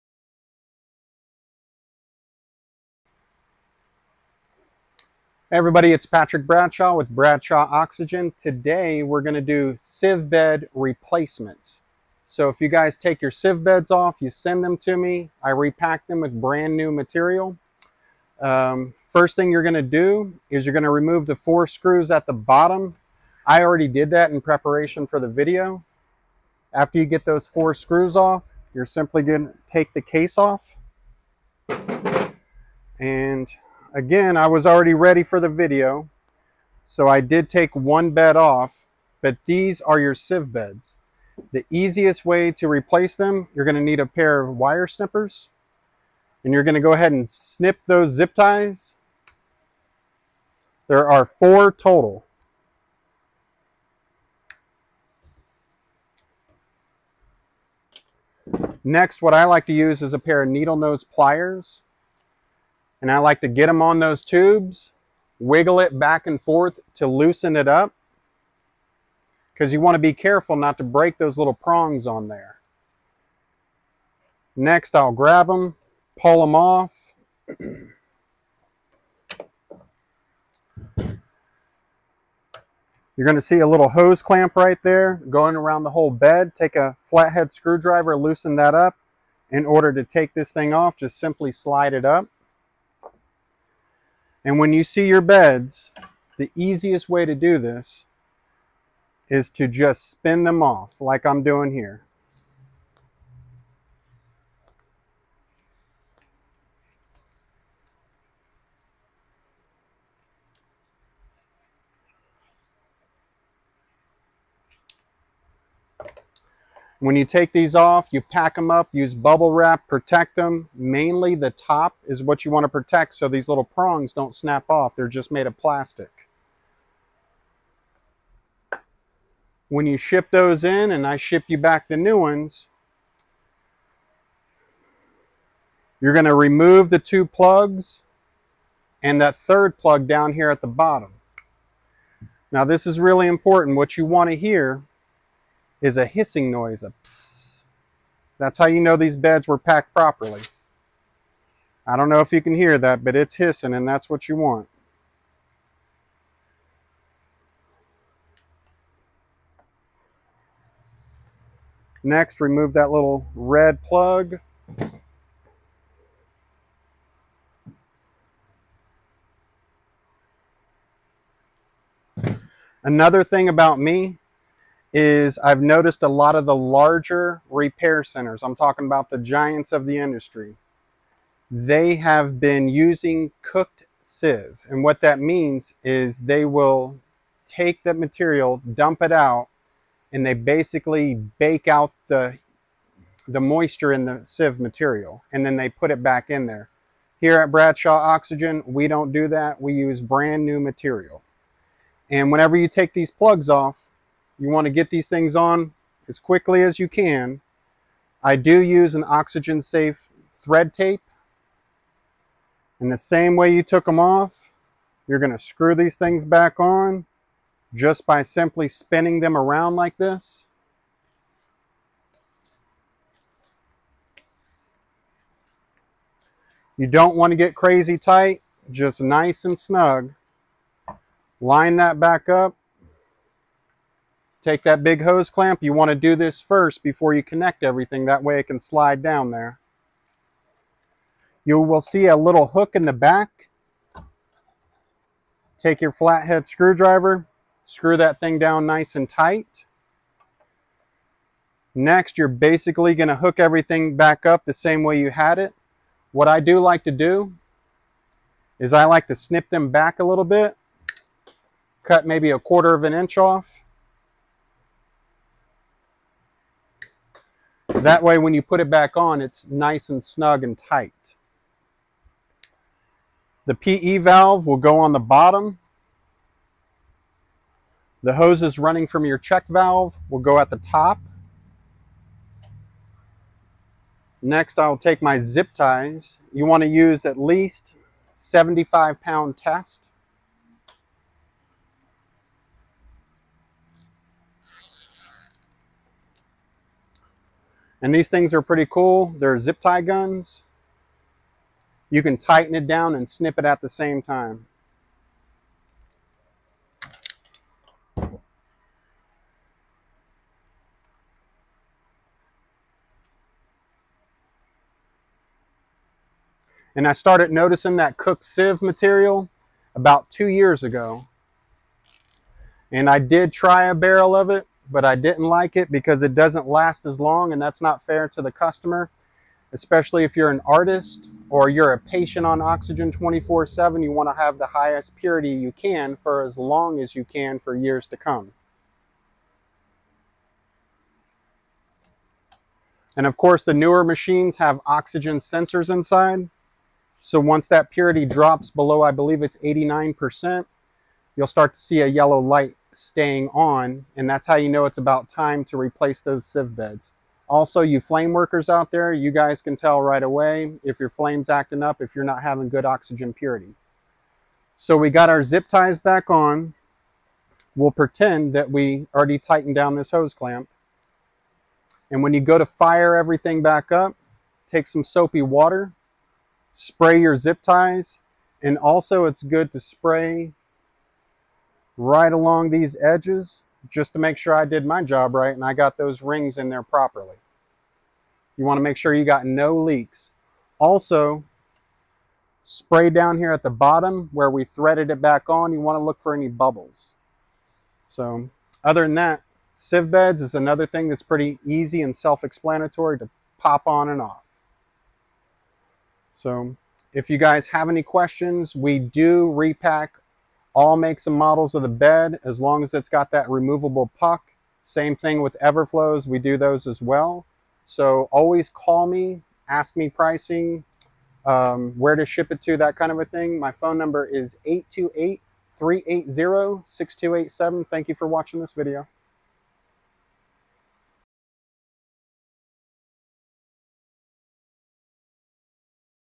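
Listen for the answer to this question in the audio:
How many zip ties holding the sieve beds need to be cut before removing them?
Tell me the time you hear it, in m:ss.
0:51.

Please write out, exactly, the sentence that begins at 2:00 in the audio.
Mainly the top is what you want to protect so these little prongs don't snap off.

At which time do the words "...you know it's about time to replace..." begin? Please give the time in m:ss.
5:54.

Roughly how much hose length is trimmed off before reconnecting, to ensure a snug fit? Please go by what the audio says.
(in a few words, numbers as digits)
A quarter of an inch.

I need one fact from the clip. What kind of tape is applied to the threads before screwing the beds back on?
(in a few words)
Oxygen safe thread tape.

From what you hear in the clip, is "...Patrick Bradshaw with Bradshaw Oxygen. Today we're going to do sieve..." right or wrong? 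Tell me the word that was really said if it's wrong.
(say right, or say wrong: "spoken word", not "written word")
right.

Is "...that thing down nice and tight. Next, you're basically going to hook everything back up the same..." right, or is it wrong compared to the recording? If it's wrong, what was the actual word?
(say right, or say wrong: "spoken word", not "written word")
right.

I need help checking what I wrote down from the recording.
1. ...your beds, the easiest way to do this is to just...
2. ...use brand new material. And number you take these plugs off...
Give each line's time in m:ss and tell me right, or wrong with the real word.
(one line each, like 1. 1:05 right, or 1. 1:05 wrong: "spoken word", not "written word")
1. 1:35 right
2. 3:19 wrong: "whenever", not "number".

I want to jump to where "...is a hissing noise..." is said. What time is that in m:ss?
2:25.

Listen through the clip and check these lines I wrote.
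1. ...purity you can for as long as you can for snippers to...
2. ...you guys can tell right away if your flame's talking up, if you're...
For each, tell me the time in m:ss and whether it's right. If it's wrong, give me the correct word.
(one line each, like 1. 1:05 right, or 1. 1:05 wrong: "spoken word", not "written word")
1. 5:34 wrong: "years", not "snippers"
2. 5:58 wrong: "acting", not "talking".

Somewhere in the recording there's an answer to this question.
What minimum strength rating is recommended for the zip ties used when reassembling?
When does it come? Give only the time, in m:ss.
4:48.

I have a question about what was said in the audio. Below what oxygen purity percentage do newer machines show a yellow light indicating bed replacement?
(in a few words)
89%.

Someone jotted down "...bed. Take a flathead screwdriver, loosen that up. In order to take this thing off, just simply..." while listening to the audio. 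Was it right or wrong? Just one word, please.
right.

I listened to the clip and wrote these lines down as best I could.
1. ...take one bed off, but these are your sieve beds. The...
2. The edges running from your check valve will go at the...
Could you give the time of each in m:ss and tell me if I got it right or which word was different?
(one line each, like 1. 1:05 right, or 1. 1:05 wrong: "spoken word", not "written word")
1. 0:37 right
2. 4:38 wrong: "hoses", not "edges".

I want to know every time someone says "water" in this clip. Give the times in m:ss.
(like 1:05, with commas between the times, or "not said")
6:15.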